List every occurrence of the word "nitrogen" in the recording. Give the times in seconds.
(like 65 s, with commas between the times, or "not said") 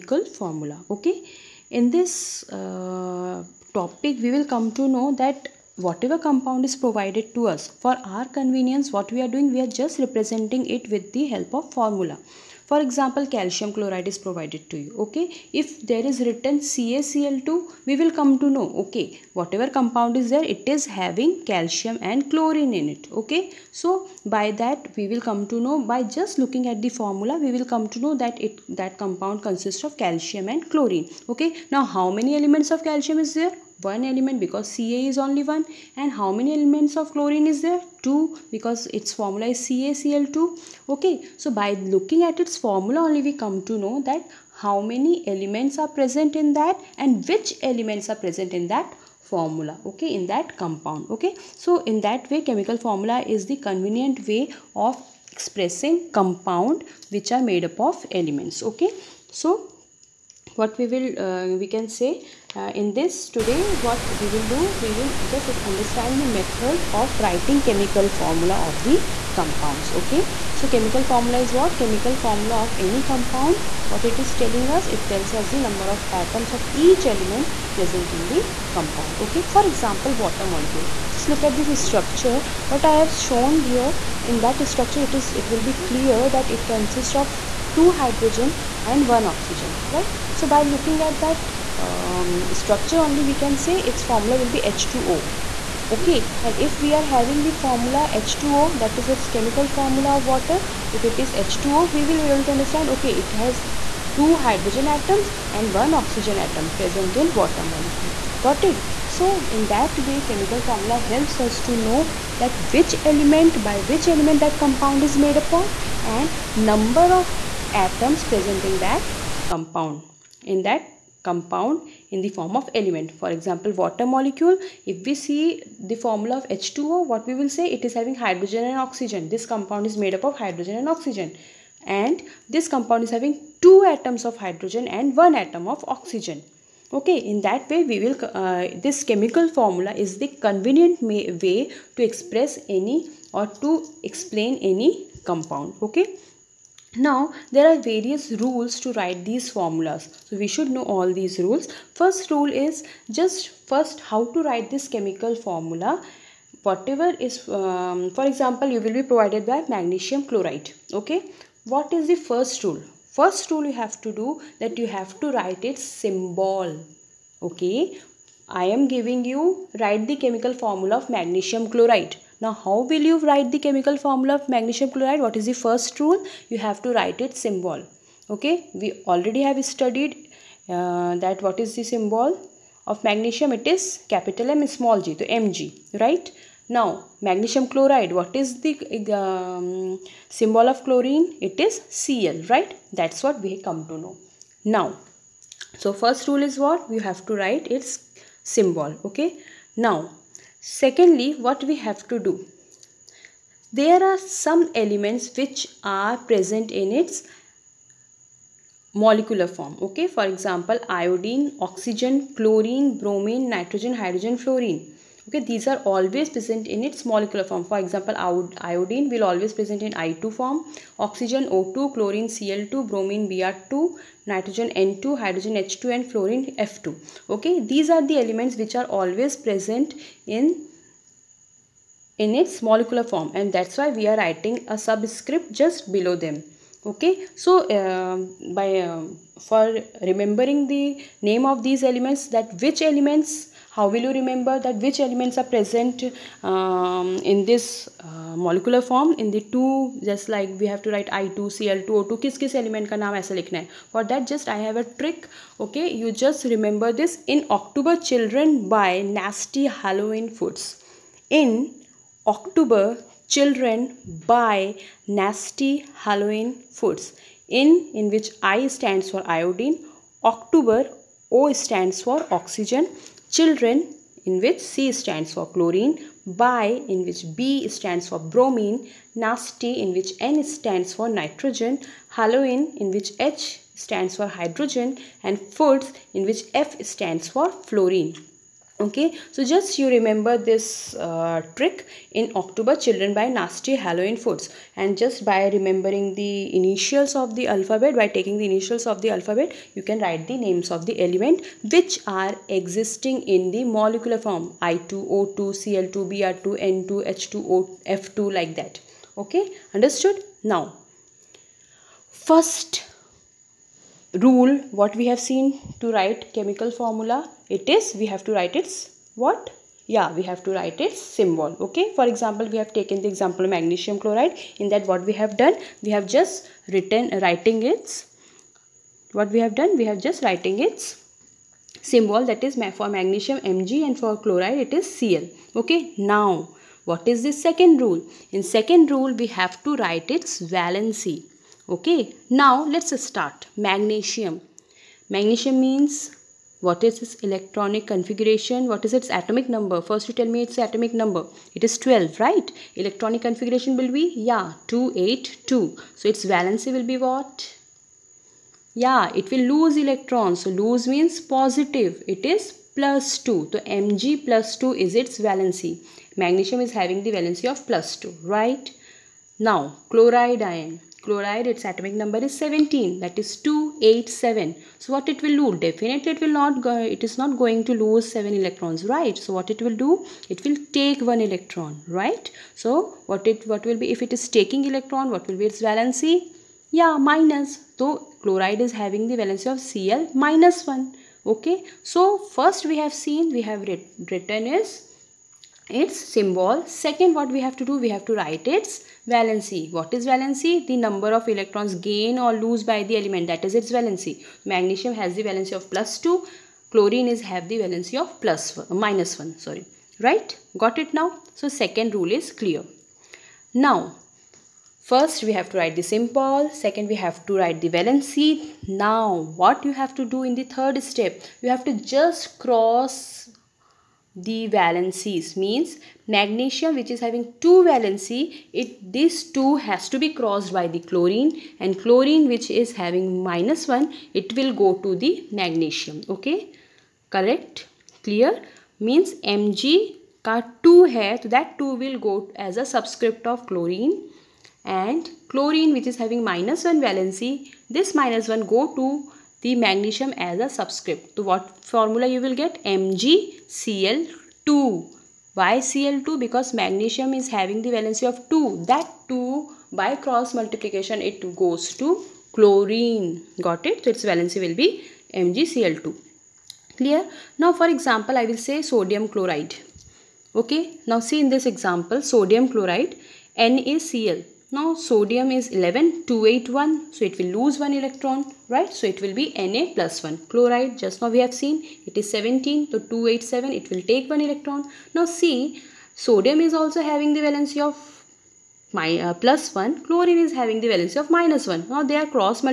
213 s, 224 s, 281 s.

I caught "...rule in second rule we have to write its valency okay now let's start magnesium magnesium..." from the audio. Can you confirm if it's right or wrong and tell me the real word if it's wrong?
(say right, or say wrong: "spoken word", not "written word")
right.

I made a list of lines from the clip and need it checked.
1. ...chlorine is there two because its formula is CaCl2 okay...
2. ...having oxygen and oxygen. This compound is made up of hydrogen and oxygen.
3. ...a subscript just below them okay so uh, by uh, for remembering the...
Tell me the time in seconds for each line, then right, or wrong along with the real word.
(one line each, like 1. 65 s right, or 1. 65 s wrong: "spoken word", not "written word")
1. 37 s right
2. 127 s wrong: "hydrogen", not "oxygen"
3. 234 s right.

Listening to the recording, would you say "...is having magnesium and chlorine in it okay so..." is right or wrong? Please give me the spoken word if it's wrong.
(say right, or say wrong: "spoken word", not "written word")
wrong: "calcium", not "magnesium".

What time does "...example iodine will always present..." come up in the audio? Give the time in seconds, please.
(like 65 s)
217 s.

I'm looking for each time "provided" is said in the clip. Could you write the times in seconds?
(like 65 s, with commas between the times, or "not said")
6 s, 14 s, 159 s.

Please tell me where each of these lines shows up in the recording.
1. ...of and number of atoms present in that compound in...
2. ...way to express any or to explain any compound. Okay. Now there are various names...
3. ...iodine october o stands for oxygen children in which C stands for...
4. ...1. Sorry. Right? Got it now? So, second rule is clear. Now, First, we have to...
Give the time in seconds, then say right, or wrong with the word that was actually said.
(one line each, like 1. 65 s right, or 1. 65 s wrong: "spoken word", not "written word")
1. 115 s right
2. 141 s wrong: "rules", not "names"
3. 269 s right
4. 409 s right.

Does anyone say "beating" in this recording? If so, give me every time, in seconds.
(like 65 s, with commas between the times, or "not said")
not said.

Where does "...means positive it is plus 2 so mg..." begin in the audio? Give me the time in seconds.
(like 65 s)
360 s.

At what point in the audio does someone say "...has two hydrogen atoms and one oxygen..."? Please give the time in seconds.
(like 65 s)
103 s.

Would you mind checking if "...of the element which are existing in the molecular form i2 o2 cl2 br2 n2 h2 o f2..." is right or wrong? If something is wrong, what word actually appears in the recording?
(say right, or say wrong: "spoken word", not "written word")
right.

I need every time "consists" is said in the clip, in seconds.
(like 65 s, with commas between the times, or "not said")
29 s, 86 s.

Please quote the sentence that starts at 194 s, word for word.
Now, so first rule is what?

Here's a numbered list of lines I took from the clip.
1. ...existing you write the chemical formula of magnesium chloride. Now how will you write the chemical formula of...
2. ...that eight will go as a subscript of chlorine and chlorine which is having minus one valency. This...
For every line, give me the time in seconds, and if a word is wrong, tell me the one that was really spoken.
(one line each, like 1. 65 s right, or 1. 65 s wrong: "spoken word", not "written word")
1. 168 s wrong: "giving", not "existing"
2. 441 s wrong: "two", not "eight".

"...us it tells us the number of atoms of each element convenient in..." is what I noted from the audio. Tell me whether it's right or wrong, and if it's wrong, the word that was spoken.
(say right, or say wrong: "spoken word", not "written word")
wrong: "present", not "convenient".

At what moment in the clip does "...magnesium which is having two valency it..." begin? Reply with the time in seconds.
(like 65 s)
426 s.